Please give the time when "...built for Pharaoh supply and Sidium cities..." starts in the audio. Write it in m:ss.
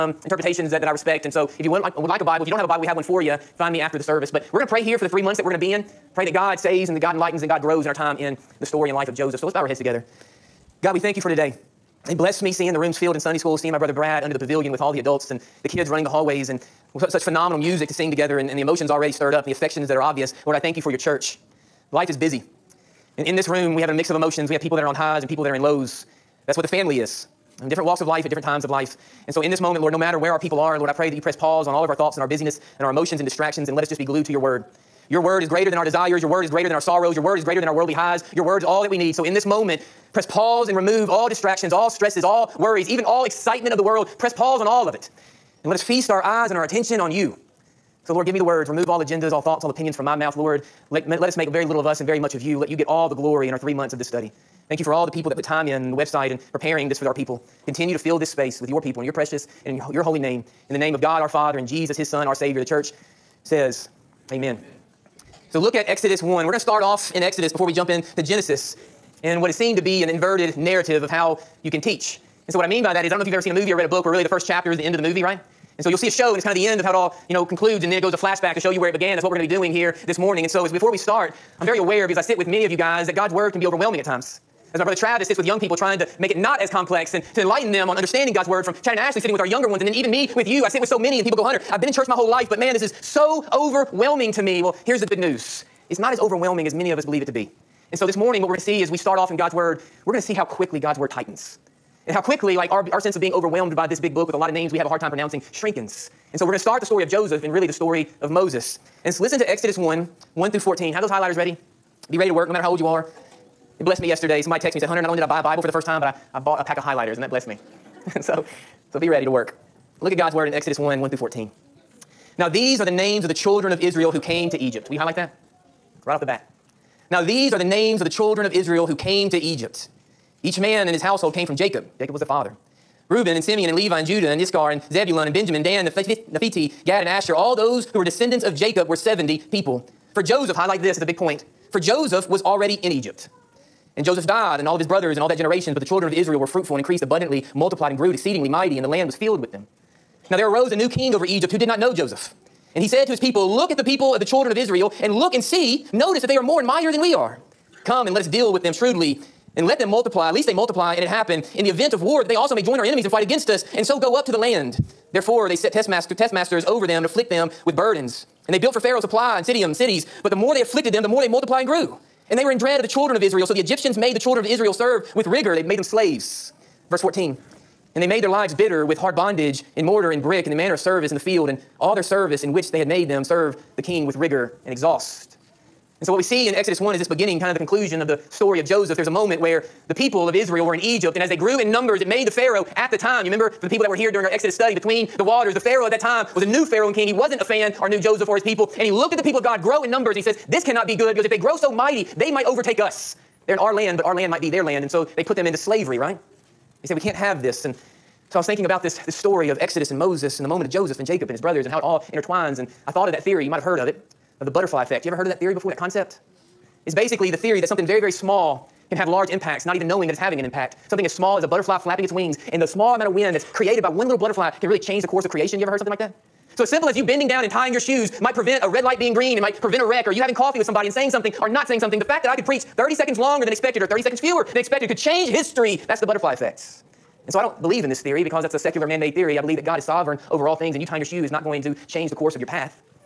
2:48.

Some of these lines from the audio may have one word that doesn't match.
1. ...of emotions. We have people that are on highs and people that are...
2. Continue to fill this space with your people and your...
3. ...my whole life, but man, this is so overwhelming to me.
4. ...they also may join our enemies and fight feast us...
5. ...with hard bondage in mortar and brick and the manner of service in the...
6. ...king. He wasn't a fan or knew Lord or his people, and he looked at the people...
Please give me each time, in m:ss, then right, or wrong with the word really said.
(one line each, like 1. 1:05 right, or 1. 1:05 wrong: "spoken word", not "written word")
1. 0:24 right
2. 0:57 right
3. 1:32 right
4. 2:42 wrong: "against", not "feast"
5. 2:58 right
6. 3:16 wrong: "Joseph", not "Lord".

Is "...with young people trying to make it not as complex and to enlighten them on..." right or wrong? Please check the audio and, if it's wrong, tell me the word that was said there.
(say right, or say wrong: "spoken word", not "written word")
right.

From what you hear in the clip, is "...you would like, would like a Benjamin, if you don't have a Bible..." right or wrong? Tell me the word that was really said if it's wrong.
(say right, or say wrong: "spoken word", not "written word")
wrong: "Bible", not "Benjamin".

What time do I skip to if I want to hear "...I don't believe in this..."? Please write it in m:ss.
3:57.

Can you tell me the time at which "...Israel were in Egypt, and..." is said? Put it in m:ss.
3:10.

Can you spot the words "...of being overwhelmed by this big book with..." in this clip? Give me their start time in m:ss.
1:43.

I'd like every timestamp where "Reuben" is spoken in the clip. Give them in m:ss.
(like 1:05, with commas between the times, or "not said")
2:13.